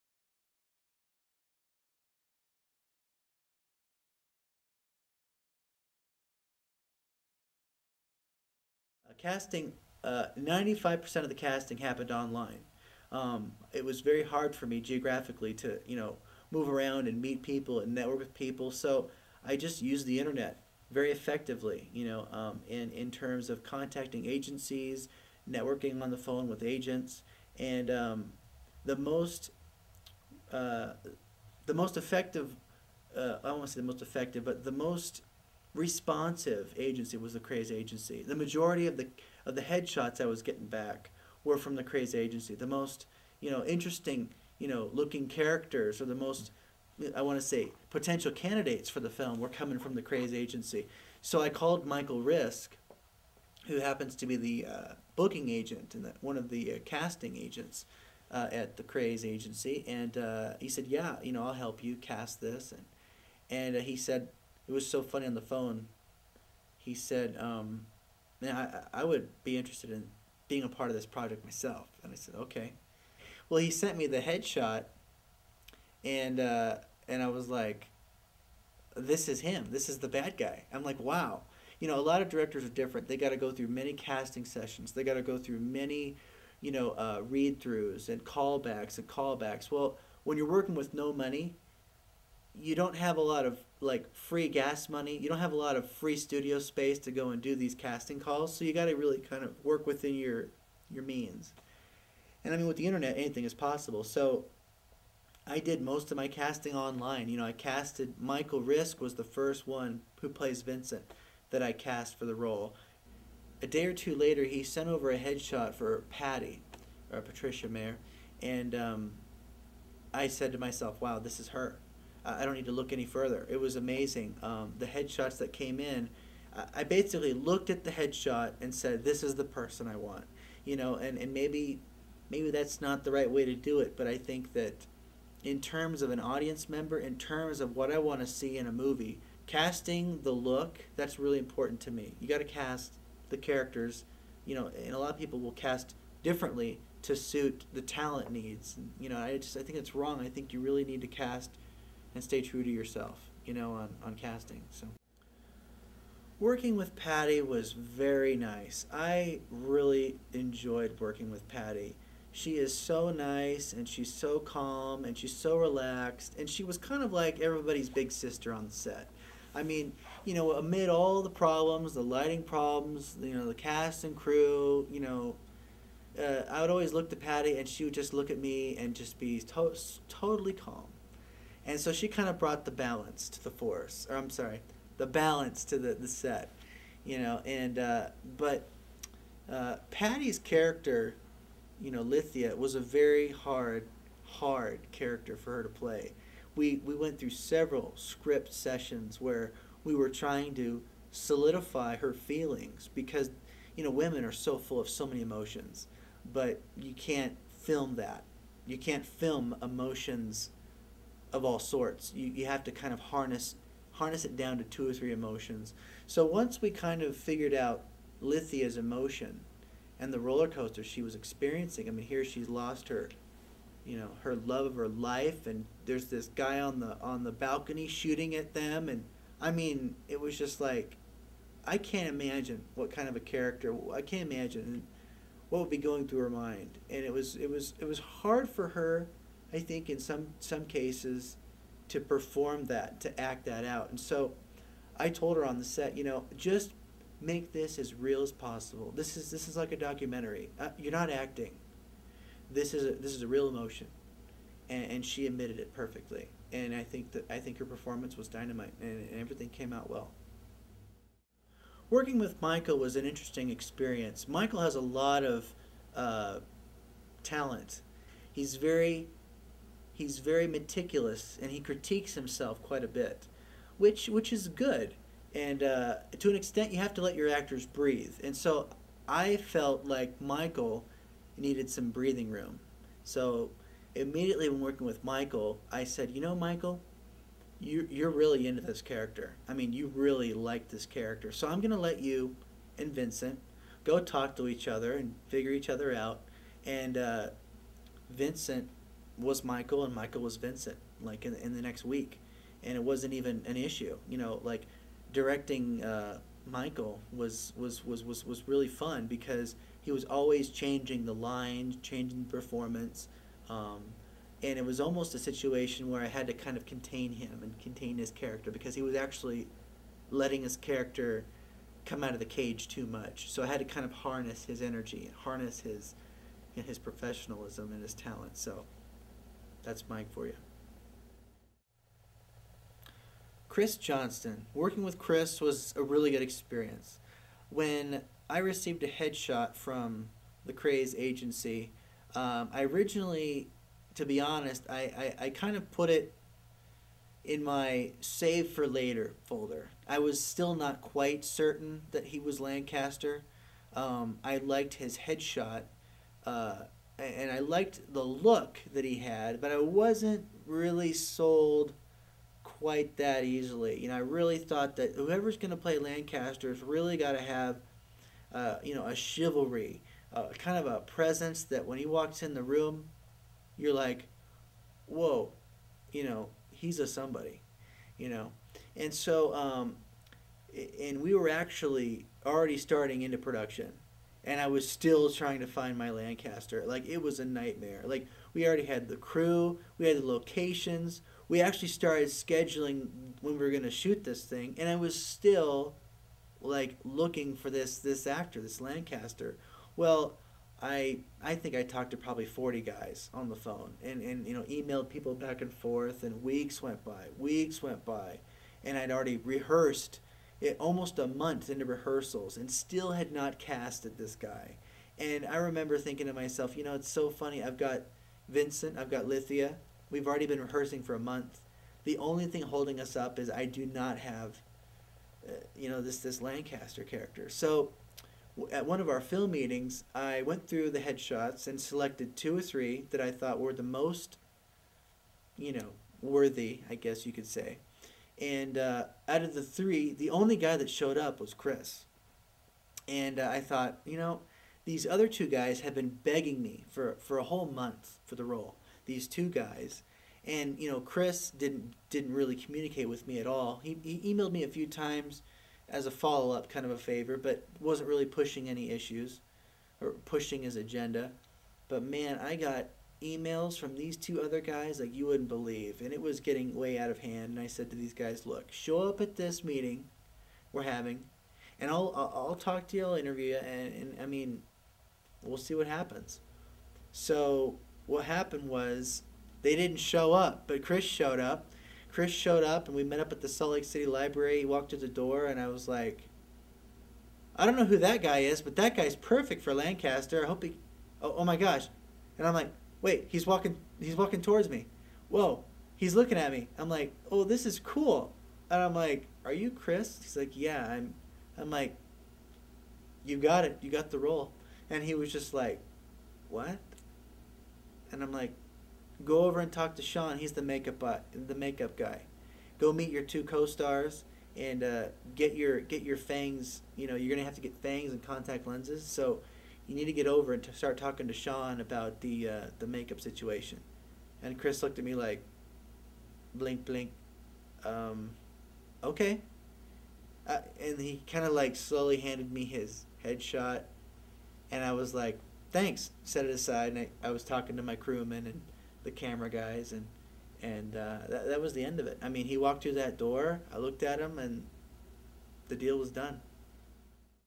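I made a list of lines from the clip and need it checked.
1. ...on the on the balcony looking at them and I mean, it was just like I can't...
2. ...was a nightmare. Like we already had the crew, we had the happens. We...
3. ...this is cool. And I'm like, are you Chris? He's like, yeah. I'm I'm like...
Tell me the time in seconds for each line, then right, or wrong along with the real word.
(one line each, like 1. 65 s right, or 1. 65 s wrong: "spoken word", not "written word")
1. 226 s wrong: "shooting", not "looking"
2. 387 s wrong: "locations", not "happens"
3. 497 s right.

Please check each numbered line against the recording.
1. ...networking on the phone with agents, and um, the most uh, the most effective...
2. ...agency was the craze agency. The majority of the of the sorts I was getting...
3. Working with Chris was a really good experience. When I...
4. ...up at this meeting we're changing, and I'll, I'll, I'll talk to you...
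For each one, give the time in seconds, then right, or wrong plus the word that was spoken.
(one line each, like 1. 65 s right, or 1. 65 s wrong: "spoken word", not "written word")
1. 25 s right
2. 36 s wrong: "headshots", not "sorts"
3. 334 s right
4. 468 s wrong: "having", not "changing".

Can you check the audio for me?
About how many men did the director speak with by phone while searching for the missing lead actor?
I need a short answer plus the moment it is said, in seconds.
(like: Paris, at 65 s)
40, at 402 s.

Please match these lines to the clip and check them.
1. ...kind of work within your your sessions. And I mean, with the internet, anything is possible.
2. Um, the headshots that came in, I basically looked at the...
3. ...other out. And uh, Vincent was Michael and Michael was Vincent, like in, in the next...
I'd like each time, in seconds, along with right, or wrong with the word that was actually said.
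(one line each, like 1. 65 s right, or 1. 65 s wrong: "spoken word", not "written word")
1. 99 s wrong: "means", not "sessions"
2. 124 s right
3. 295 s right.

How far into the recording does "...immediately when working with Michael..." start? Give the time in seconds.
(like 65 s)
283 s.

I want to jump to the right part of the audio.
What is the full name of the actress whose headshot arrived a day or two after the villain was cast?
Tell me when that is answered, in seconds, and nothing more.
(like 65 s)
117 s.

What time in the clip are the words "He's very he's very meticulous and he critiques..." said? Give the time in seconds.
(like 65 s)
268 s.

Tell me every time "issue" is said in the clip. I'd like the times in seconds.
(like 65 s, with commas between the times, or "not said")
303 s, 458 s.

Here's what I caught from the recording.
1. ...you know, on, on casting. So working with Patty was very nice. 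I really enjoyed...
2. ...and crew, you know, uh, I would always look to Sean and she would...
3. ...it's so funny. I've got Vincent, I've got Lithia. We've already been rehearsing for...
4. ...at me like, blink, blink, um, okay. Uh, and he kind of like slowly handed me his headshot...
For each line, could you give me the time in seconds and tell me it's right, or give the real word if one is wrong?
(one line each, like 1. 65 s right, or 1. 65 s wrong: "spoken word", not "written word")
1. 153 s right
2. 174 s wrong: "Patty", not "Sean"
3. 416 s right
4. 524 s right.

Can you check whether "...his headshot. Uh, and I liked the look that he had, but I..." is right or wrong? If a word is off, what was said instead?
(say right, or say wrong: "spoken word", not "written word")
right.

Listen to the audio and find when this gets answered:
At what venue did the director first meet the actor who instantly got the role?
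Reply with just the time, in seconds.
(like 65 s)
483 s.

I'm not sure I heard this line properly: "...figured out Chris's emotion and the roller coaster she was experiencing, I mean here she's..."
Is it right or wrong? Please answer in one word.
wrong.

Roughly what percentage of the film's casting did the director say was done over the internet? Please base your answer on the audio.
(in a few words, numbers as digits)
95%.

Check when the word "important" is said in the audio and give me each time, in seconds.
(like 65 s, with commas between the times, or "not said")
141 s.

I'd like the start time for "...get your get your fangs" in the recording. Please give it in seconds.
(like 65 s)
515 s.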